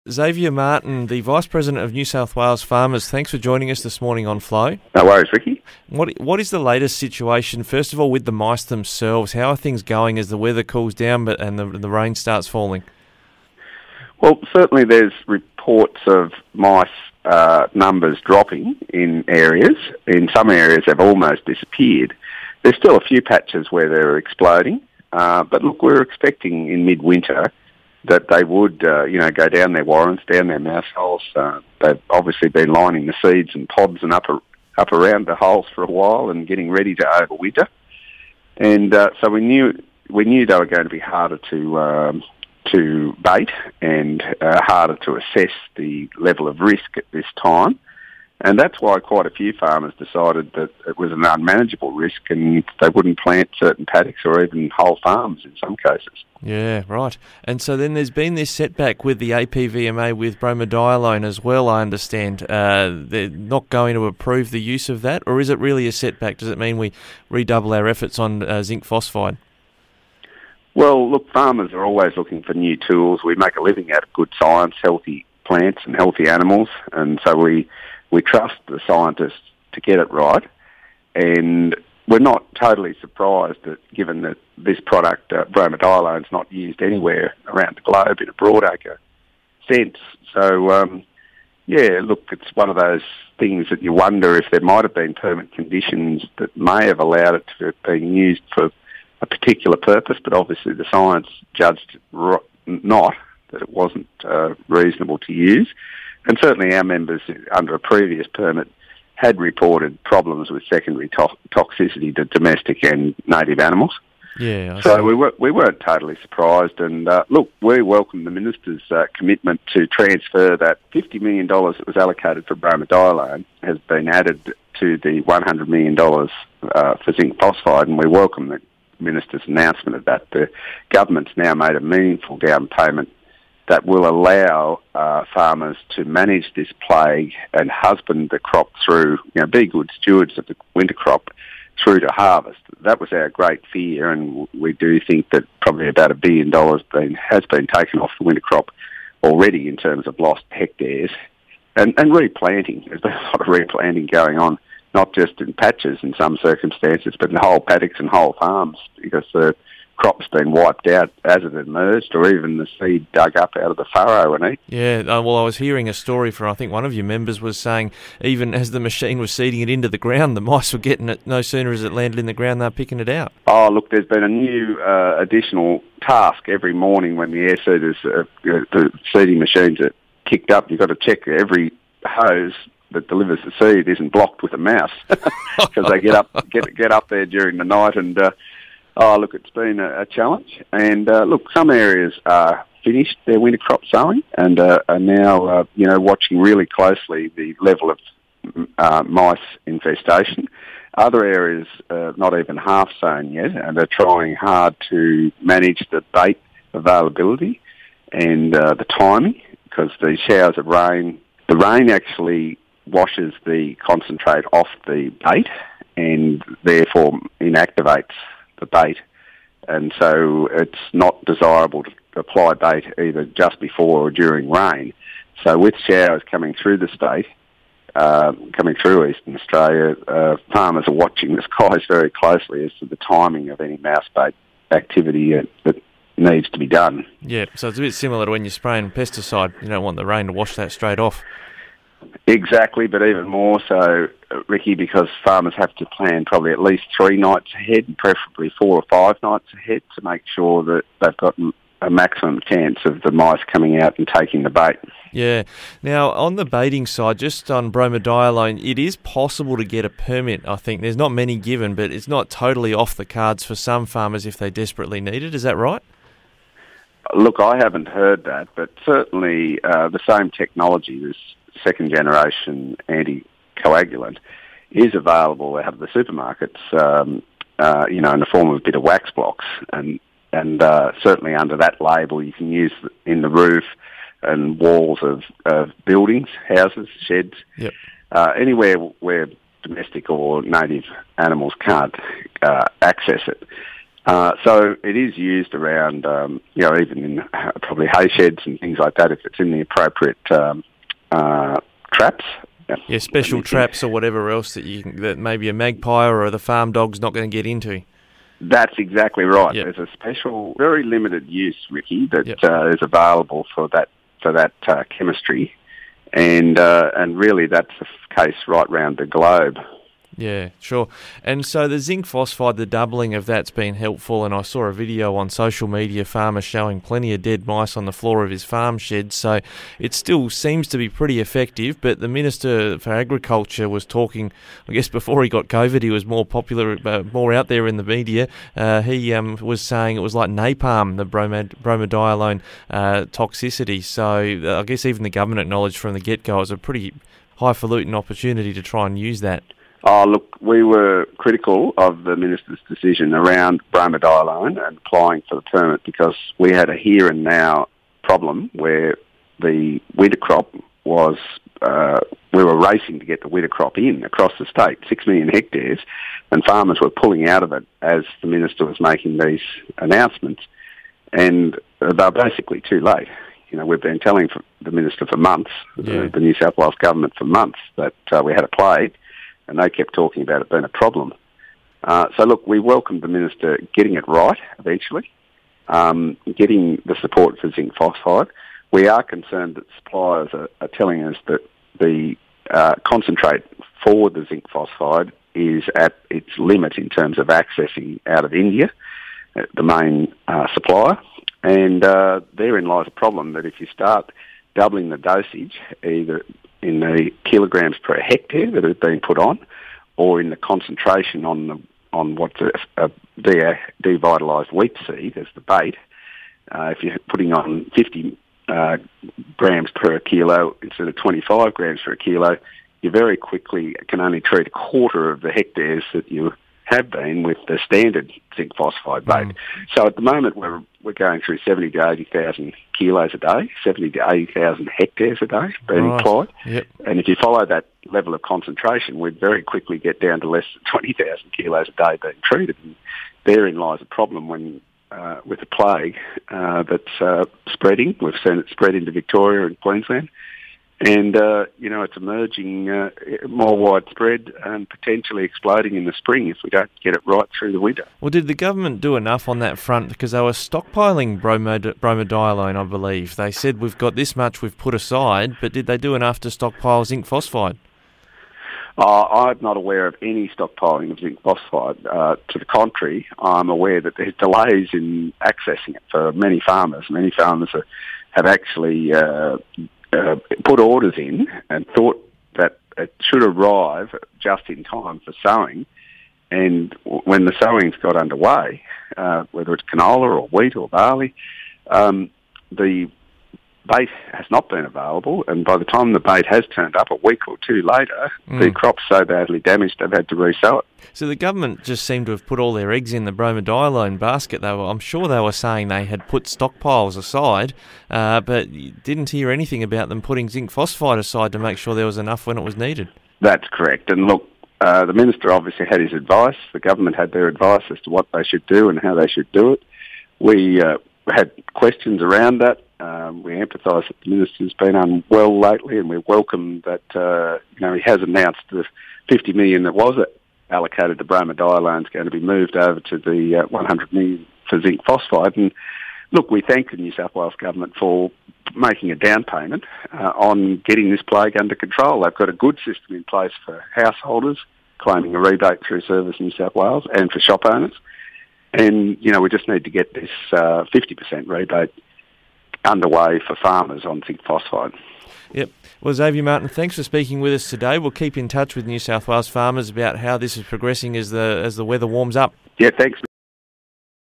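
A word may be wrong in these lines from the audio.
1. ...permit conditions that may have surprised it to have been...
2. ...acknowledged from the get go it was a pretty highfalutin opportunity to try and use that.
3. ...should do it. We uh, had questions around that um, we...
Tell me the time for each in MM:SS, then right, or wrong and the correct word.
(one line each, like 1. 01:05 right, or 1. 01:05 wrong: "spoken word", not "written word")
1. 01:35 wrong: "allowed", not "surprised"
2. 05:45 right
3. 08:39 right.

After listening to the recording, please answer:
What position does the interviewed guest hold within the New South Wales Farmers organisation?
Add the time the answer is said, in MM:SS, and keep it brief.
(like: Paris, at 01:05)
Vice President, at 00:01.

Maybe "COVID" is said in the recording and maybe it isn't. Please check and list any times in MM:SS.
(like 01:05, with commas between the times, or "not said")
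05:35.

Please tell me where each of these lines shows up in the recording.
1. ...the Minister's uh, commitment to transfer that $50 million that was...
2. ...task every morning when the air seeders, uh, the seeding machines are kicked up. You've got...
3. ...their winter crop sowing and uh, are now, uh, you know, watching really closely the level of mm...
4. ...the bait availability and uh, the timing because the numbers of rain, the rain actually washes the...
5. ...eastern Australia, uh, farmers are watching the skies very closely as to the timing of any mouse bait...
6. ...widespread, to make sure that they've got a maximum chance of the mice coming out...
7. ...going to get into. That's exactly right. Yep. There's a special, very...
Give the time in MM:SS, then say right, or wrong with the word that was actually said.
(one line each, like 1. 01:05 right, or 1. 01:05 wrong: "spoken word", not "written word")
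1. 01:58 right
2. 02:56 right
3. 03:13 right
4. 03:25 wrong: "showers", not "numbers"
5. 03:49 right
6. 04:09 wrong: "ahead", not "widespread"
7. 05:07 right.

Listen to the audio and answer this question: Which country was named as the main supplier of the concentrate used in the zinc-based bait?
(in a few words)
India.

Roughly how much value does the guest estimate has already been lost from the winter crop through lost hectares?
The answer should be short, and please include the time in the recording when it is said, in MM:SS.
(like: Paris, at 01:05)
a billion dollars, at 02:26.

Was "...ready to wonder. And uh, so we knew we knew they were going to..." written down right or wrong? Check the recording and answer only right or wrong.
wrong.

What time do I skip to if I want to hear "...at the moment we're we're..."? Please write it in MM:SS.
07:09.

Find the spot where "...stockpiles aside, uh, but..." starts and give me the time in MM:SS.
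08:26.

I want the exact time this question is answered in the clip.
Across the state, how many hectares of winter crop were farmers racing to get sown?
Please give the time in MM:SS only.
06:04.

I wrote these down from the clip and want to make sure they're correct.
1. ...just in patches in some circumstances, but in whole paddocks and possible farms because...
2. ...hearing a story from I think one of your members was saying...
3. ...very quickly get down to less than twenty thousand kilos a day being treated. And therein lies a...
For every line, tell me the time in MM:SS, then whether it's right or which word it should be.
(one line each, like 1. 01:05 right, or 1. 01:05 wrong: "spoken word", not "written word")
1. 02:35 wrong: "whole", not "possible"
2. 02:45 right
3. 07:19 right.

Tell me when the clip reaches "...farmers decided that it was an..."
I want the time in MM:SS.
00:49.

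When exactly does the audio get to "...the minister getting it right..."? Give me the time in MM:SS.
06:23.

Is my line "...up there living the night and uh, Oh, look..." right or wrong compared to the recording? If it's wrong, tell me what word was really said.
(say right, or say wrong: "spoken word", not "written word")
wrong: "during", not "living".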